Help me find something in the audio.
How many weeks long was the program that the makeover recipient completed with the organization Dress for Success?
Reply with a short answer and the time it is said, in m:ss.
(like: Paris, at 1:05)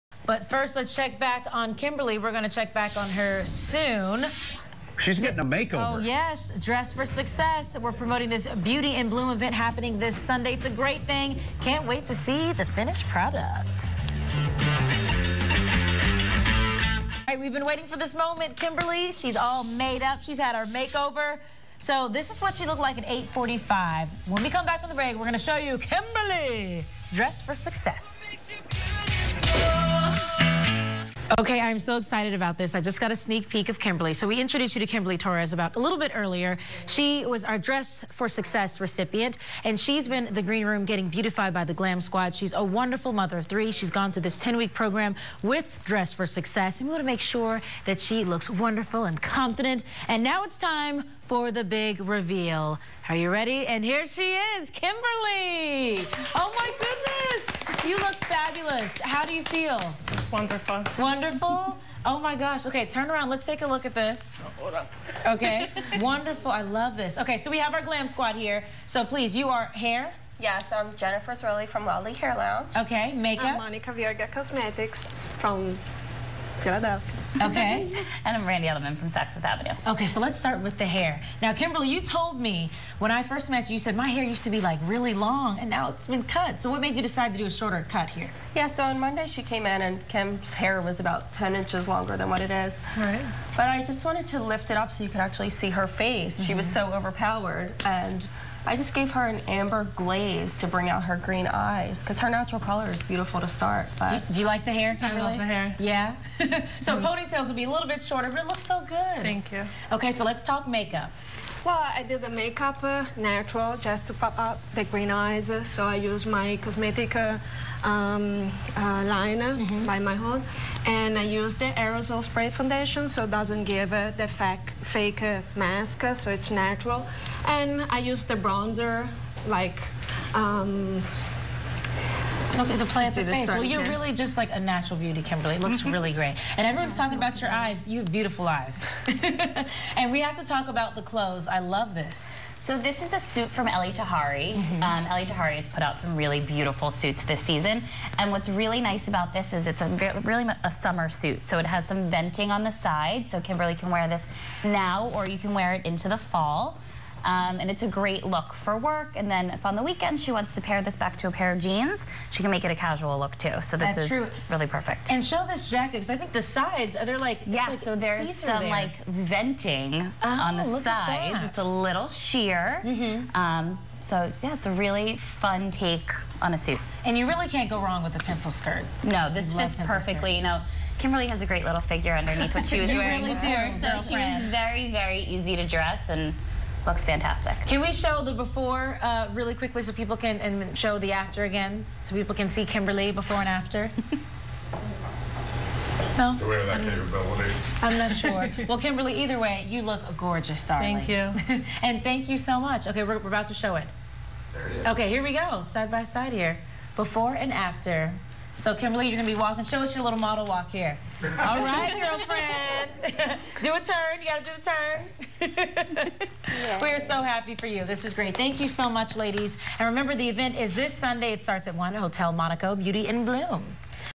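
10, at 0:44.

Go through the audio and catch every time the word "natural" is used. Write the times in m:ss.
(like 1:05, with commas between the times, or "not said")
1:42, 1:53, 2:06, 2:14.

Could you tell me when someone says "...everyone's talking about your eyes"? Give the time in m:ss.
2:16.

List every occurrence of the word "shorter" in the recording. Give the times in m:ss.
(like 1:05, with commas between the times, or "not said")
1:27, 1:48.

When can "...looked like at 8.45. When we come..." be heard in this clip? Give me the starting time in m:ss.
0:22.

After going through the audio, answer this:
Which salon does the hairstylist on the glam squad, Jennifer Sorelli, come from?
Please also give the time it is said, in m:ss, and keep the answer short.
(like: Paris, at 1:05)
La'lli Hair Lounge, at 1:11.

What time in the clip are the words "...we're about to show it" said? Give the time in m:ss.
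3:23.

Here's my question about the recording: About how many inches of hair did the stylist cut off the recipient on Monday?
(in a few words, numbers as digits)
10.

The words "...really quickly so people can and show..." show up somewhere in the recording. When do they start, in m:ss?
3:09.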